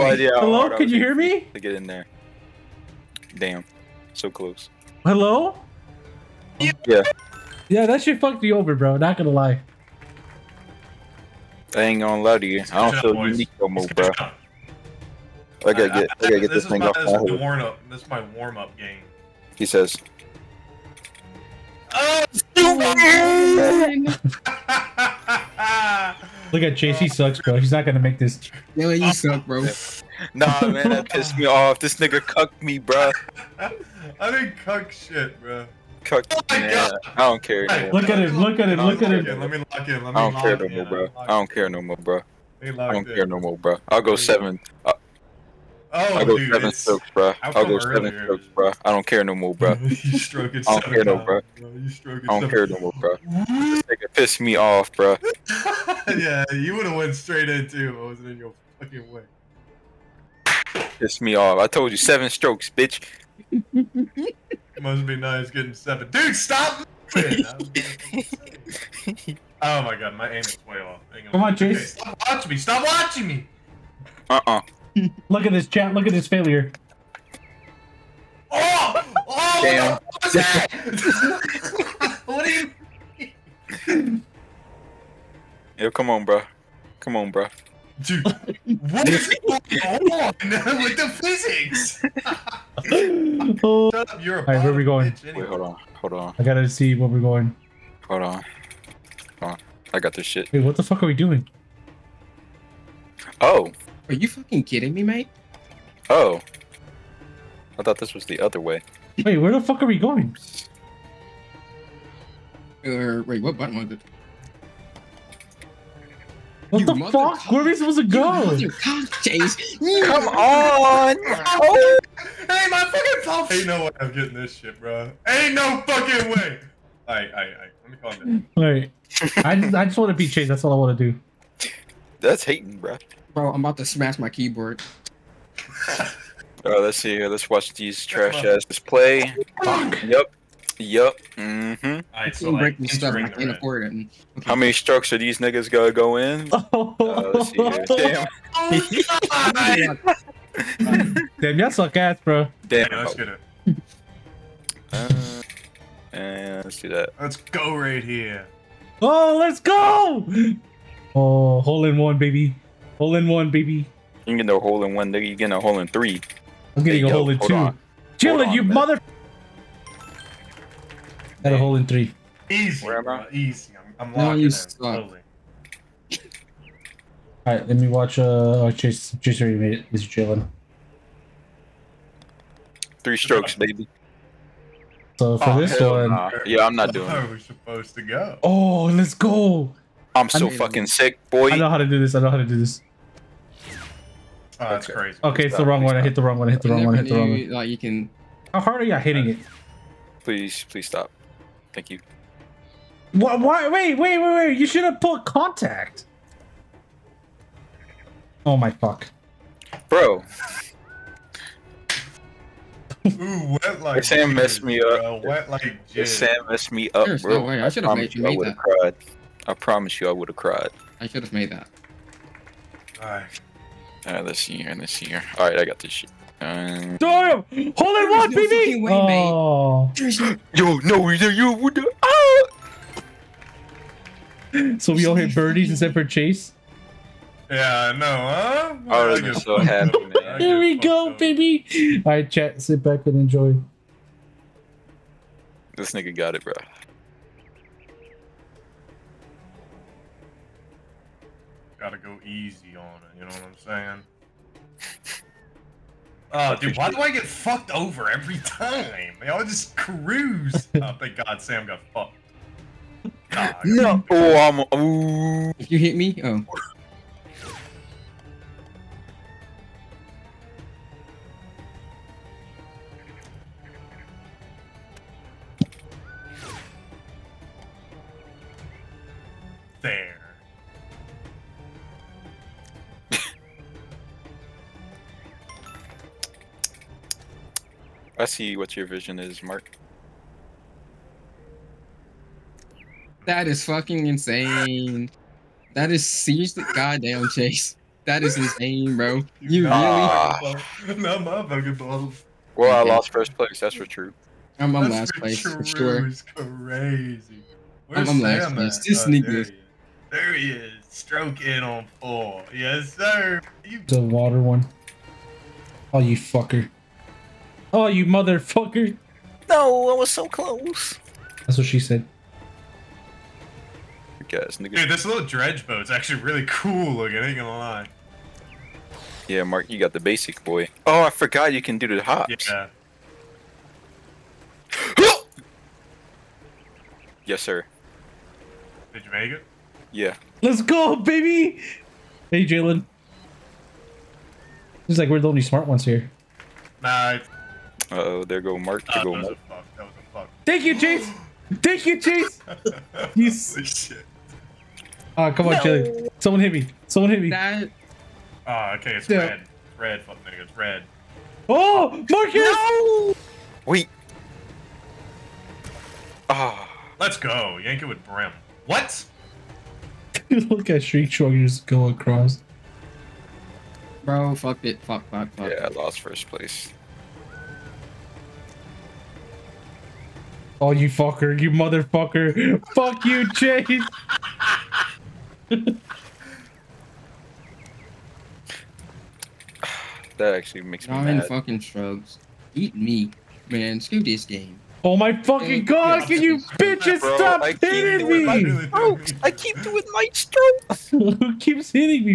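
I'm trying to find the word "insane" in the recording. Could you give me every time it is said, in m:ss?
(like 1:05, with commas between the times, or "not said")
4:54, 4:58.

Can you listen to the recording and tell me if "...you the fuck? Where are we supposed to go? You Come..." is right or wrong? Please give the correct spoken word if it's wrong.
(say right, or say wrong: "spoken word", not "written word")
right.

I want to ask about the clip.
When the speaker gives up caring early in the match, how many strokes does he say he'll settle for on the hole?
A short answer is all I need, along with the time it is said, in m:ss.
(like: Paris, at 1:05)
7, at 0:43.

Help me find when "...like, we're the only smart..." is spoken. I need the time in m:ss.
5:44.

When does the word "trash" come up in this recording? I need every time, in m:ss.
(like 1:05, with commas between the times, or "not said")
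2:18.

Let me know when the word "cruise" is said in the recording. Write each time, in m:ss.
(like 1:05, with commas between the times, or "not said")
4:19.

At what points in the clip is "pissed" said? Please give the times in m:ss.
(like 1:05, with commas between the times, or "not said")
0:31, 0:54, 1:00.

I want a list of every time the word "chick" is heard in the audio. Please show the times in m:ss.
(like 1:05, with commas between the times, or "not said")
not said.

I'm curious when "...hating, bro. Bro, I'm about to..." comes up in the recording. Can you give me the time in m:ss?
2:12.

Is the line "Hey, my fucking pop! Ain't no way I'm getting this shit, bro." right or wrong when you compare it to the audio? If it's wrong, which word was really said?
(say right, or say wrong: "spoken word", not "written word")
right.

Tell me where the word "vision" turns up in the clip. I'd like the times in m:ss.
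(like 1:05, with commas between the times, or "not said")
4:48.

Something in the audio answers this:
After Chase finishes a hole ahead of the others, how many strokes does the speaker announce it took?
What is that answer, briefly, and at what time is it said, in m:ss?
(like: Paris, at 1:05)
3, at 3:03.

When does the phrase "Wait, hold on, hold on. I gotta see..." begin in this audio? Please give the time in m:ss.
1:35.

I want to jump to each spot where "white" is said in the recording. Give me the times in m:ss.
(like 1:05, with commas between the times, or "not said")
not said.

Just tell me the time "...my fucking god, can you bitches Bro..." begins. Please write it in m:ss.
6:34.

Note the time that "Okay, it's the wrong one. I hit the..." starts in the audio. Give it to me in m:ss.
3:15.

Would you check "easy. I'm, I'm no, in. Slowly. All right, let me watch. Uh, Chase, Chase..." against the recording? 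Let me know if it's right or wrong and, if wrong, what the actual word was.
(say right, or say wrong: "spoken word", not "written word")
right.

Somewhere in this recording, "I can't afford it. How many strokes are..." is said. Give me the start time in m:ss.
2:23.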